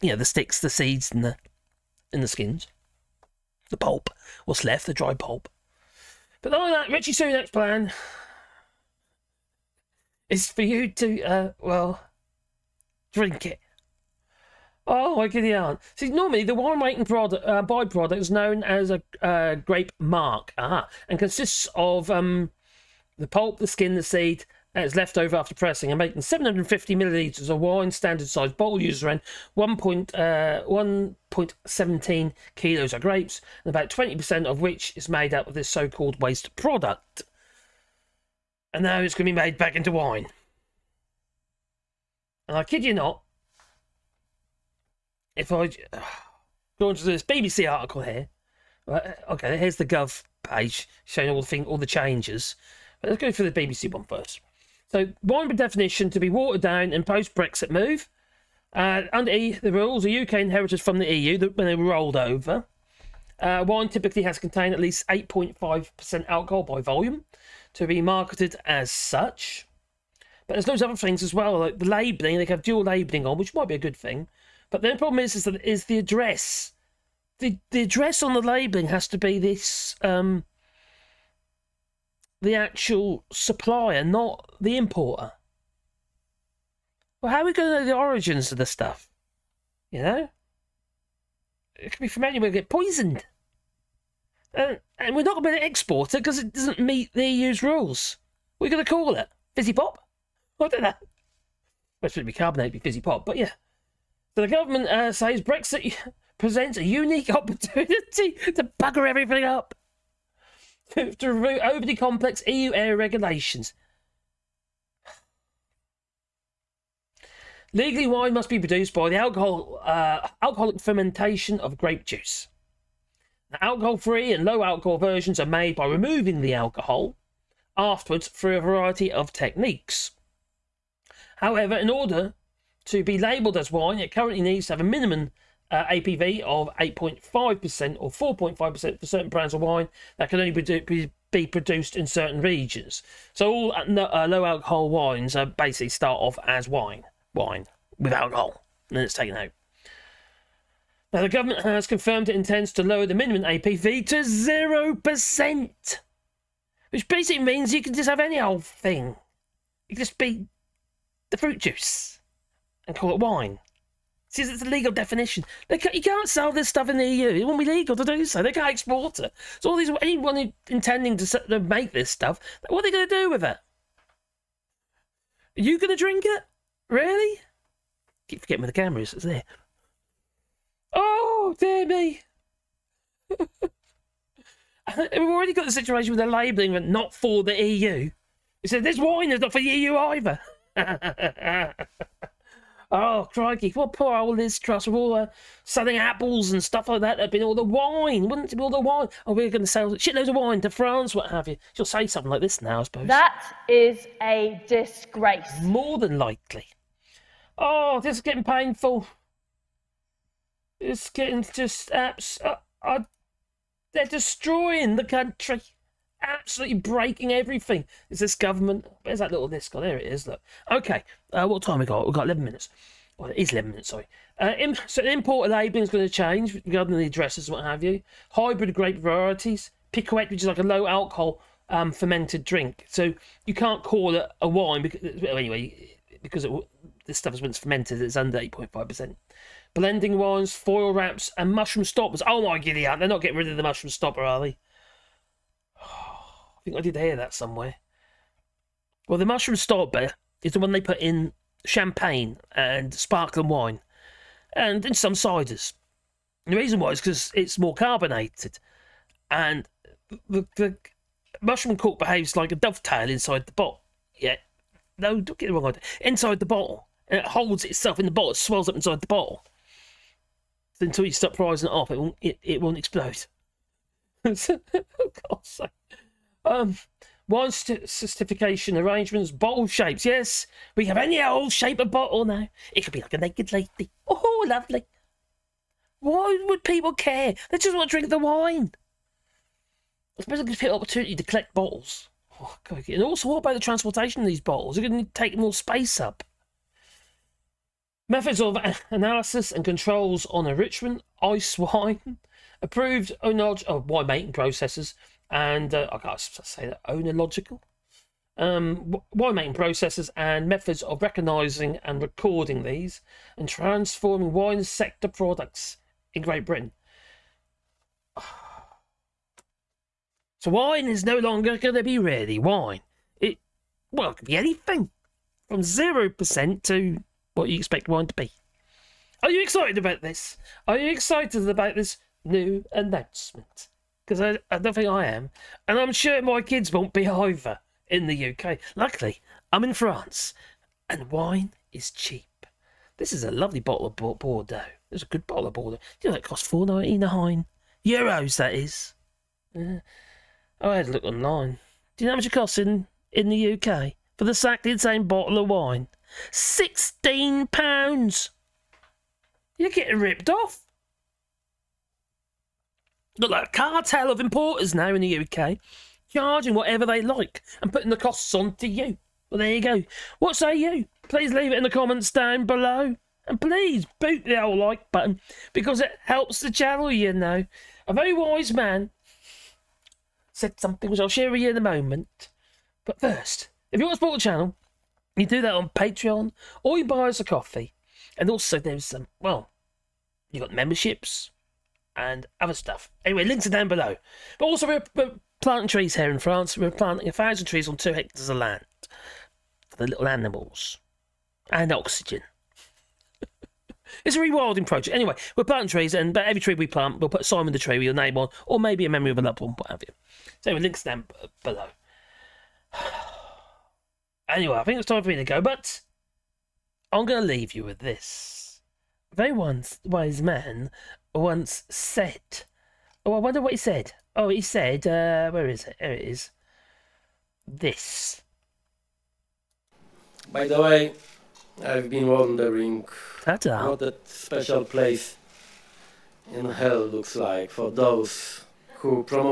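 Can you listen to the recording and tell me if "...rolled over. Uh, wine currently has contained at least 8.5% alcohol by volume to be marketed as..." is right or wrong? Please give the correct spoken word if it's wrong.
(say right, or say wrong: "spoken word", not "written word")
wrong: "typically", not "currently".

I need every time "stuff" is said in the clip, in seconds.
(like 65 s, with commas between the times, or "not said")
88 s, 166 s, 172 s, 196 s, 237 s, 392 s.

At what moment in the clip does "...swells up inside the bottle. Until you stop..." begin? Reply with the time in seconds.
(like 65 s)
268 s.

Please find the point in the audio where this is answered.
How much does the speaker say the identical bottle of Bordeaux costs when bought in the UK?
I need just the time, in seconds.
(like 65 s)
356 s.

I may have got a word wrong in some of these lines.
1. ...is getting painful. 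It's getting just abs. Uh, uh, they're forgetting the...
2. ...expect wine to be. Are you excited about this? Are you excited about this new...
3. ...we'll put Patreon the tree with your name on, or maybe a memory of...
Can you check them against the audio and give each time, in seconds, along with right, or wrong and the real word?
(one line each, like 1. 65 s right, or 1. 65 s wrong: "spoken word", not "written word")
1. 208 s wrong: "destroying", not "forgetting"
2. 327 s right
3. 406 s wrong: "Simon", not "Patreon".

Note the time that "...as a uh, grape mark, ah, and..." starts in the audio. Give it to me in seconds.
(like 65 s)
18 s.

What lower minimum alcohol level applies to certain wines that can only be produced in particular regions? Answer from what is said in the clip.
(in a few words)
4.5%.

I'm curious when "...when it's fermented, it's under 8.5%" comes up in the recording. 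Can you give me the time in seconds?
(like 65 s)
237 s.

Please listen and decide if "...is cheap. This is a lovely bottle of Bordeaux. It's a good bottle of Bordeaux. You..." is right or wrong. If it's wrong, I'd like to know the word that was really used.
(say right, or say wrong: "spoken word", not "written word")
right.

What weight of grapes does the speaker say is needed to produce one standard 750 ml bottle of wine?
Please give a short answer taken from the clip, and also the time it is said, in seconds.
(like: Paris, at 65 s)
1.17 kilos, at 29 s.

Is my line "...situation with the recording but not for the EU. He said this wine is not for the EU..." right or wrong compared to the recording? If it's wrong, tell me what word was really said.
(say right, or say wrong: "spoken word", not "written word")
wrong: "labelling", not "recording".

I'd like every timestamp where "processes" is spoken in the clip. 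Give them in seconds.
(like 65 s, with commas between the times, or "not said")
304 s, 309 s.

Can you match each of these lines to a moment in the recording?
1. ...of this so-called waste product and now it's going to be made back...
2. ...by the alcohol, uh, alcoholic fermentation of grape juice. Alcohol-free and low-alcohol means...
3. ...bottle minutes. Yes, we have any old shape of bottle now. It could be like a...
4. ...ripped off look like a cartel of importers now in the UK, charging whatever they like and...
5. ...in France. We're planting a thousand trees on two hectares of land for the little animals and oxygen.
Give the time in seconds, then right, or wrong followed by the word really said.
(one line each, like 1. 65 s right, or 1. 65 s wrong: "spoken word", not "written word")
1. 35 s right
2. 118 s wrong: "versions", not "means"
3. 279 s wrong: "shapes", not "minutes"
4. 359 s right
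5. 396 s right.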